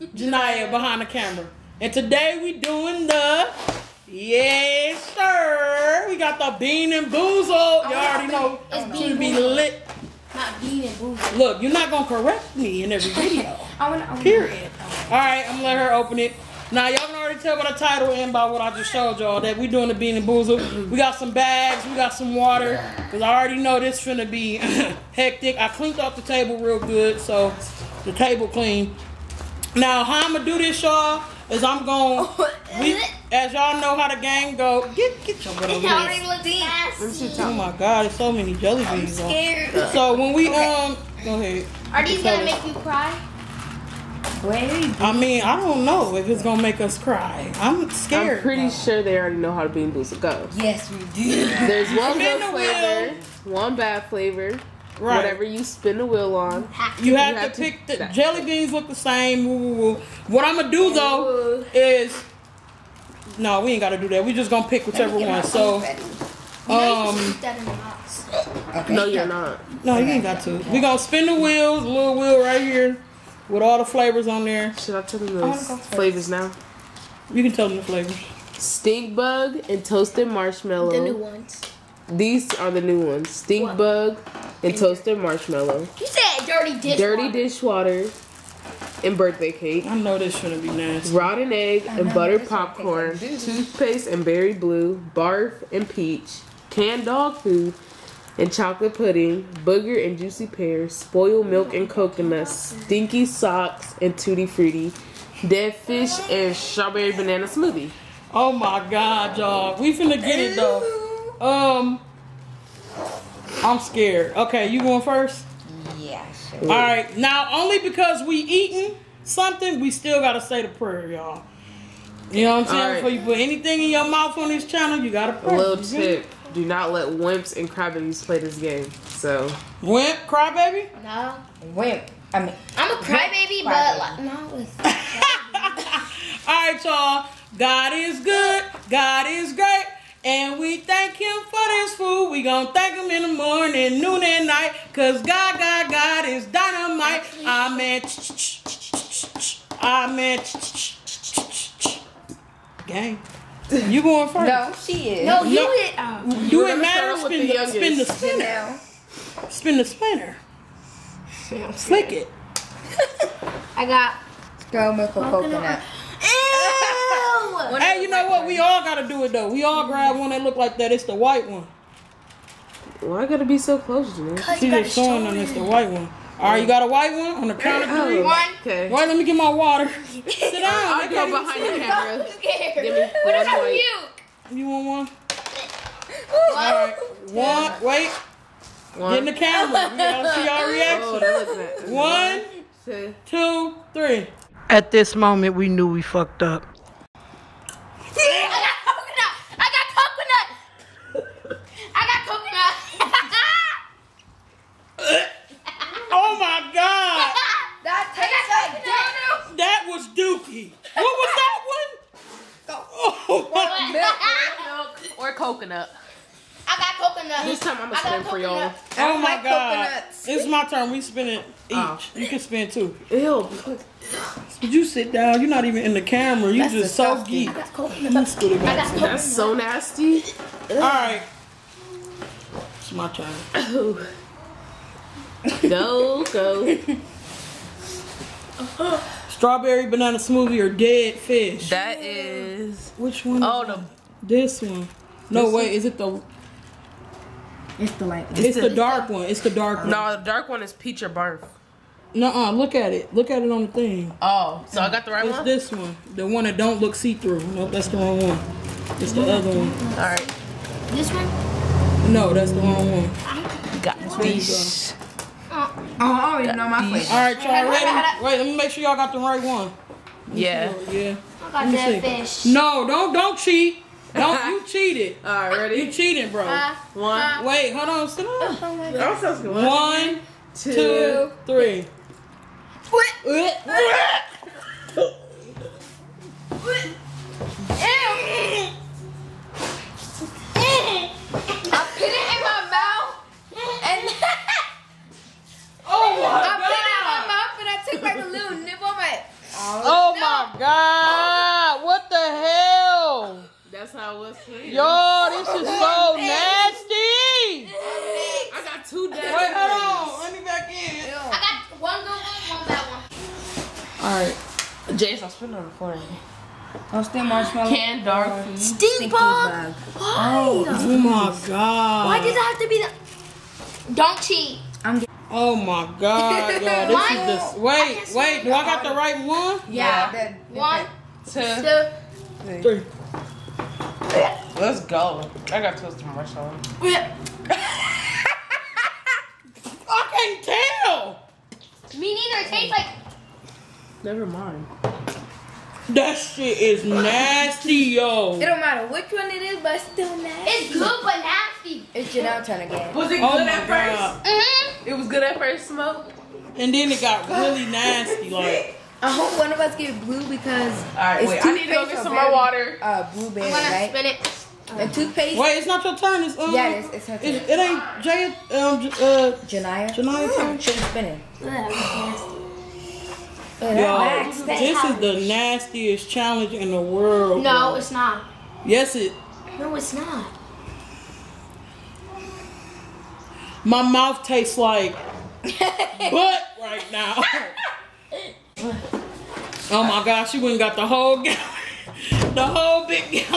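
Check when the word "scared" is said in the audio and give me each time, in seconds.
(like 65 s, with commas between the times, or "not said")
39 s, 47 s, 113 s, 182 s.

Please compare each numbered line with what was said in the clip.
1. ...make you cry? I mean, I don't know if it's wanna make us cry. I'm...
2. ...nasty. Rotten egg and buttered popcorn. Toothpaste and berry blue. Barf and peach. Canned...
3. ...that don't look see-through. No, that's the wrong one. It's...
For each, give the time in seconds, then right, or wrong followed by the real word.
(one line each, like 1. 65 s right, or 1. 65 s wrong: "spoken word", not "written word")
1. 42 s wrong: "gonna", not "wanna"
2. 90 s right
3. 256 s right.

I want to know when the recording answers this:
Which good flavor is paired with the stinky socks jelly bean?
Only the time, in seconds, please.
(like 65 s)
104 s.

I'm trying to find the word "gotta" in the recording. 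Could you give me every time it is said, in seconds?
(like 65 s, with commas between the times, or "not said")
63 s, 120 s, 125 s, 168 s, 173 s, 189 s.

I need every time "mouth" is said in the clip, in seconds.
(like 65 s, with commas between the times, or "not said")
124 s, 292 s, 297 s, 383 s.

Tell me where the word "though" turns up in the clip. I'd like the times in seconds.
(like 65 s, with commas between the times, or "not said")
60 s, 110 s, 169 s.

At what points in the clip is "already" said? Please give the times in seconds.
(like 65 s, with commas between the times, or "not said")
7 s, 17 s, 23 s, 49 s, 266 s.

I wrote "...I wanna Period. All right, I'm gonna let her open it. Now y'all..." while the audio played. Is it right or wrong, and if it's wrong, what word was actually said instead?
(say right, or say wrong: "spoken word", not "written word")
right.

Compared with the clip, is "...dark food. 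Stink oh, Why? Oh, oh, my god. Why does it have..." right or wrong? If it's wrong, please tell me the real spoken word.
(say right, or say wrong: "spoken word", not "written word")
right.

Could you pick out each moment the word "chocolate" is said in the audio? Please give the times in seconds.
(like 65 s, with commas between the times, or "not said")
98 s.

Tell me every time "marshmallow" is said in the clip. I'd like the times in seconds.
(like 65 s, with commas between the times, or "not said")
80 s, 85 s, 317 s, 336 s.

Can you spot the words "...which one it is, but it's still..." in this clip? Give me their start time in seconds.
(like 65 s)
348 s.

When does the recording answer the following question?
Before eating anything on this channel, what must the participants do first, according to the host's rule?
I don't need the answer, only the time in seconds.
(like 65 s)
125 s.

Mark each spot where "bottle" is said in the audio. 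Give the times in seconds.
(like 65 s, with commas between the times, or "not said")
not said.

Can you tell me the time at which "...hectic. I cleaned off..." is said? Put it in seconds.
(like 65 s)
25 s.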